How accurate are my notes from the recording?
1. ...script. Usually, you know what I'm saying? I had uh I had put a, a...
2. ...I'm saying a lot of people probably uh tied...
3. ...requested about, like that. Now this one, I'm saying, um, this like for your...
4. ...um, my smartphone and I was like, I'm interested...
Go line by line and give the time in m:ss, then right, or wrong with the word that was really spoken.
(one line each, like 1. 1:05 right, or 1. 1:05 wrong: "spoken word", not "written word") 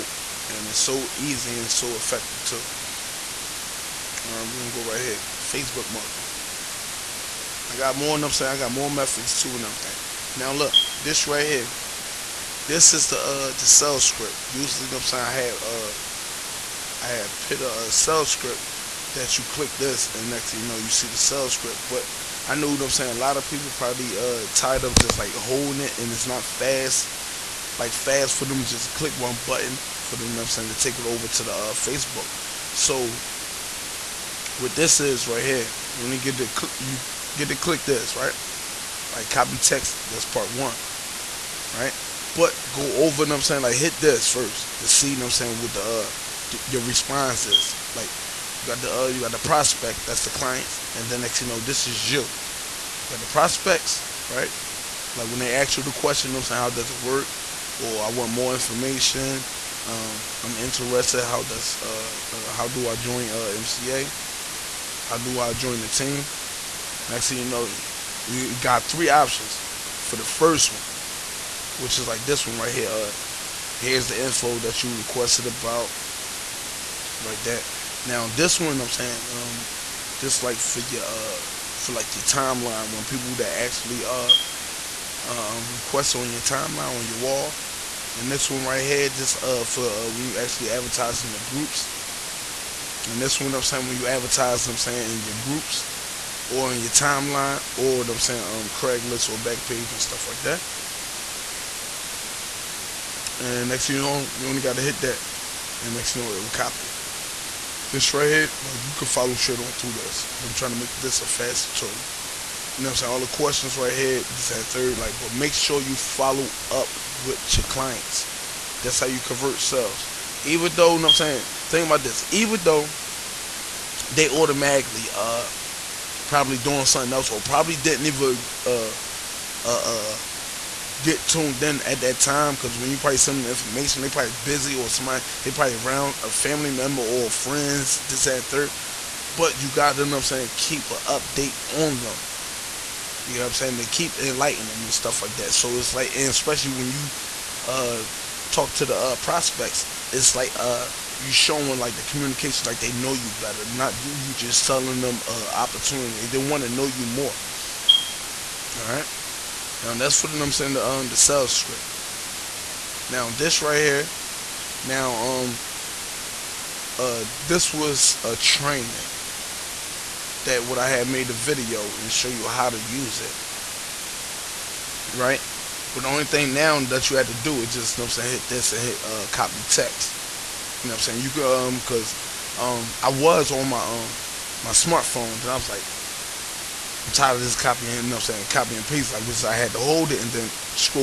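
1. 0:13 right
2. 0:22 right
3. 1:14 right
4. 3:03 wrong: "tired", not "interested".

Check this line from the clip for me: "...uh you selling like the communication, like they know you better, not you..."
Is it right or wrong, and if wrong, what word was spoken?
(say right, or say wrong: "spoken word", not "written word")
wrong: "showing", not "selling".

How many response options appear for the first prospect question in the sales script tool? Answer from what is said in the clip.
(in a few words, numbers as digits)
3.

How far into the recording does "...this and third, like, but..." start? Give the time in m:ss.
1:54.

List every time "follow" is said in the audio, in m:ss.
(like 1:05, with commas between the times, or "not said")
1:49, 1:55.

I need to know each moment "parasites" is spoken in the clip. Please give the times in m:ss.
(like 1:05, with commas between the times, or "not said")
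not said.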